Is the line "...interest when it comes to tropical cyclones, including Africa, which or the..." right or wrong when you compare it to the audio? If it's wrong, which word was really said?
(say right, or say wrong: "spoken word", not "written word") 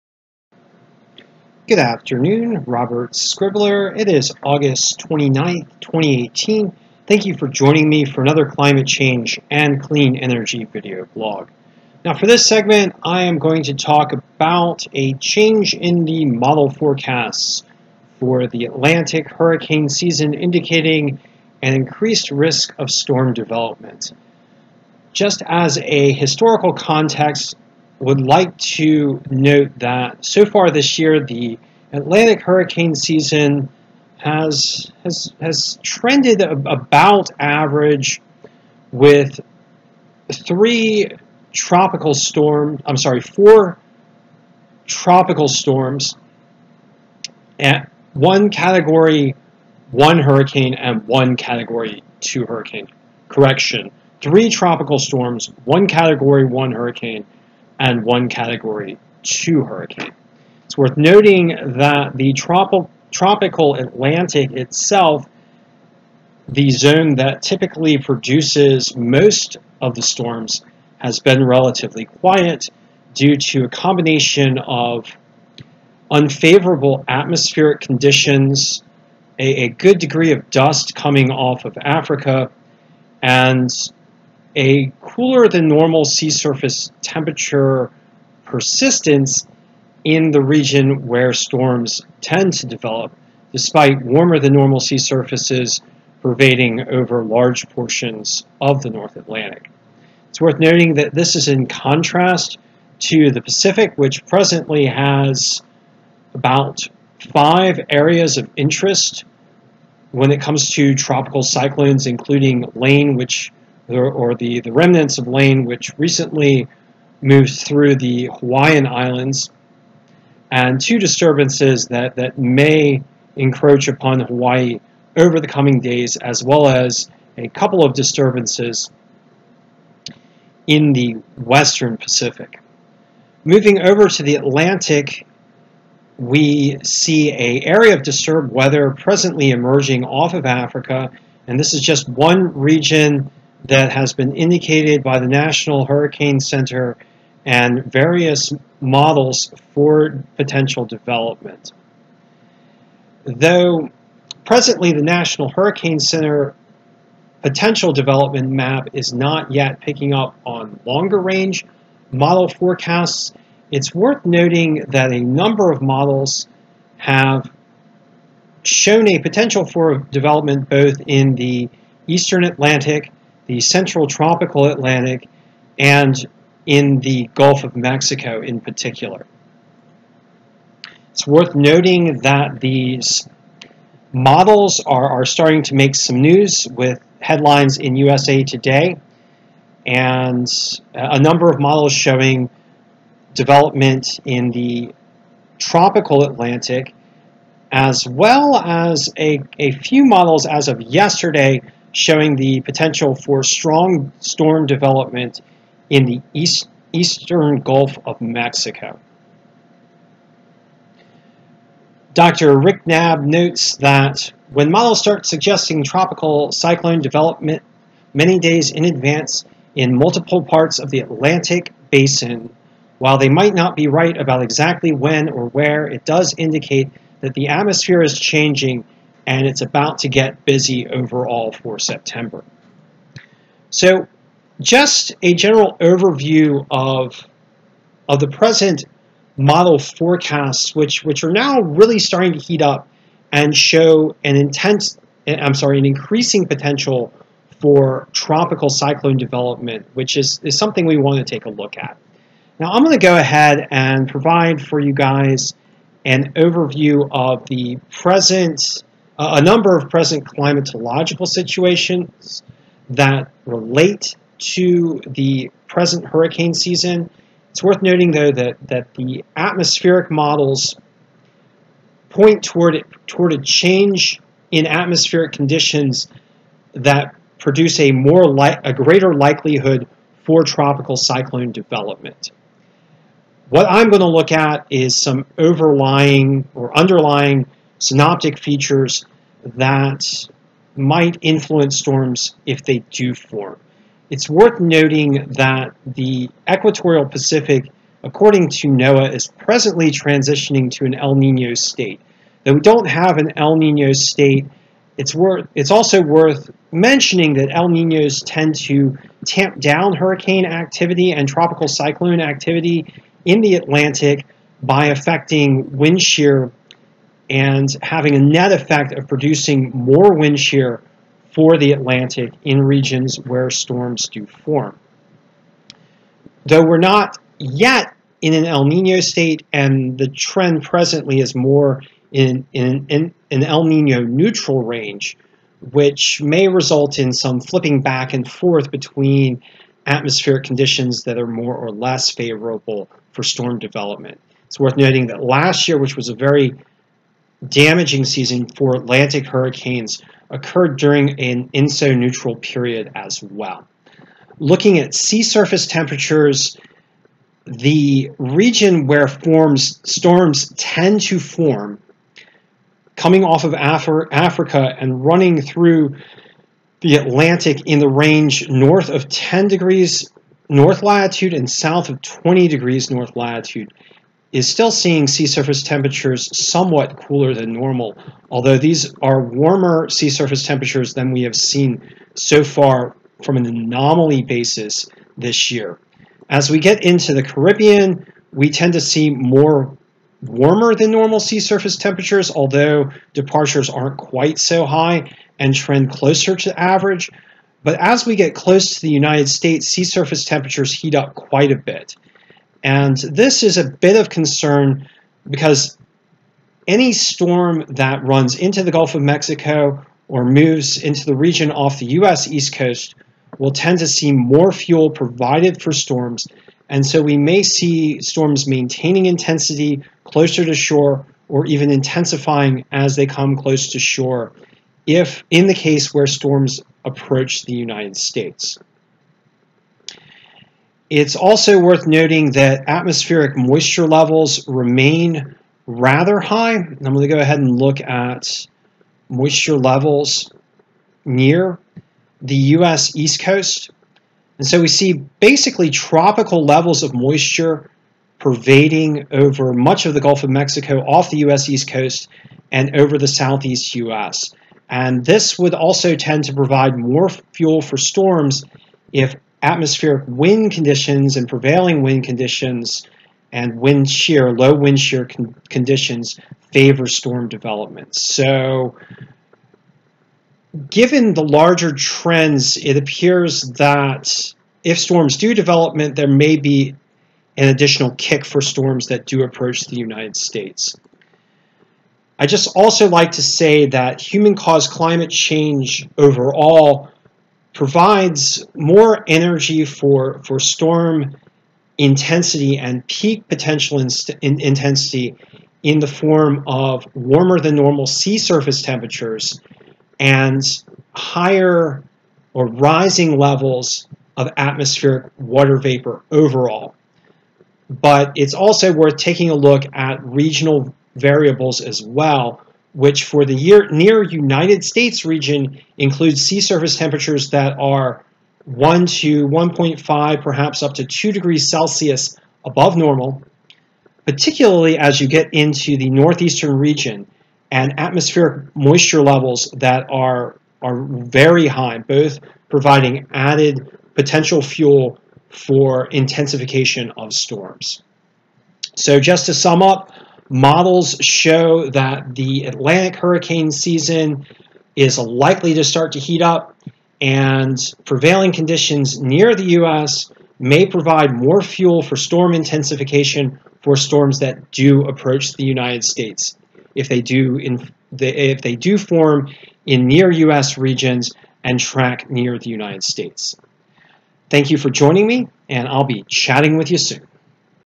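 wrong: "Lane", not "Africa".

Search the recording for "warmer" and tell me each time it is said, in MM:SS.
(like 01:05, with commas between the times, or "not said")
01:34, 06:19, 06:30, 08:16.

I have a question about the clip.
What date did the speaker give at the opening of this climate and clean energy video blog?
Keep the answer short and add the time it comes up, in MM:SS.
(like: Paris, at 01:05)
August 29th, 2018, at 00:04.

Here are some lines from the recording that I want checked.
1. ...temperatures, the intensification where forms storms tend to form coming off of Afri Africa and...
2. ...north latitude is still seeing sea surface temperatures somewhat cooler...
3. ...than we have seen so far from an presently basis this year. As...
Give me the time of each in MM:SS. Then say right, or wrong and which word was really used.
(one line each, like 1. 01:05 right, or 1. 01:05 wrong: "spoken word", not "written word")
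1. 05:55 wrong: "region", not "intensification"
2. 06:12 right
3. 06:20 wrong: "anomaly", not "presently".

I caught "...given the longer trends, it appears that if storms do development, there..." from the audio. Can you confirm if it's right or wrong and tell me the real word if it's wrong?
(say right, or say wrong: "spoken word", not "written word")
wrong: "larger", not "longer".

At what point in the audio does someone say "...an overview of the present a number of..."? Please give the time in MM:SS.
04:16.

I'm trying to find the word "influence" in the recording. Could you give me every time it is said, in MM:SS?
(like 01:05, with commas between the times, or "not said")
04:51.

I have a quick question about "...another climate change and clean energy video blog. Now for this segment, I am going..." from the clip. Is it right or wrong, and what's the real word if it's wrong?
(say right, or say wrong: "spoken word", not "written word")
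right.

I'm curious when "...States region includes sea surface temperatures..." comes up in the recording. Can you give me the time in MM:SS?
08:34.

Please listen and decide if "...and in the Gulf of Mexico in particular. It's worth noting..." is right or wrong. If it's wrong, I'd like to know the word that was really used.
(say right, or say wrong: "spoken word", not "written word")
right.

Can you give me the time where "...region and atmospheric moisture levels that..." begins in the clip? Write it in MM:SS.
08:46.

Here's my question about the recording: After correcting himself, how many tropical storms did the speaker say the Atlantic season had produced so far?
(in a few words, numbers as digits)
3.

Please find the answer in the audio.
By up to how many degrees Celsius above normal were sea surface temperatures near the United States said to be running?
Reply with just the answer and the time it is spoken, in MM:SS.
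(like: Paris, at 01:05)
2, at 08:40.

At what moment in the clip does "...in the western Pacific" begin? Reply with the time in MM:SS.
02:10.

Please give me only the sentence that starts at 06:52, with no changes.
East Coast will tend to see more fuel provided for storms.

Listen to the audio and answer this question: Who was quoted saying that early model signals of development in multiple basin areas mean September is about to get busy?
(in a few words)
Dr. Rick Knabb.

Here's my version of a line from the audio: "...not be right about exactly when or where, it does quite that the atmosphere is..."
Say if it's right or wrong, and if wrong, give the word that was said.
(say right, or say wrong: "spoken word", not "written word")
wrong: "indicate", not "quite".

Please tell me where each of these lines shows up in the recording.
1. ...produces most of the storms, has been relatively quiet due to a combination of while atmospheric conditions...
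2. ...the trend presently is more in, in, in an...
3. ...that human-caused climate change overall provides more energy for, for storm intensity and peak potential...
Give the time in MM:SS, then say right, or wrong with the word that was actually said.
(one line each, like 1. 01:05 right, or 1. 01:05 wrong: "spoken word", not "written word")
1. 01:07 wrong: "unfavorable", not "while"
2. 05:29 right
3. 08:03 right.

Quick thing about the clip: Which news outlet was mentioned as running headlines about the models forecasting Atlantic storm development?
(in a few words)
USA Today.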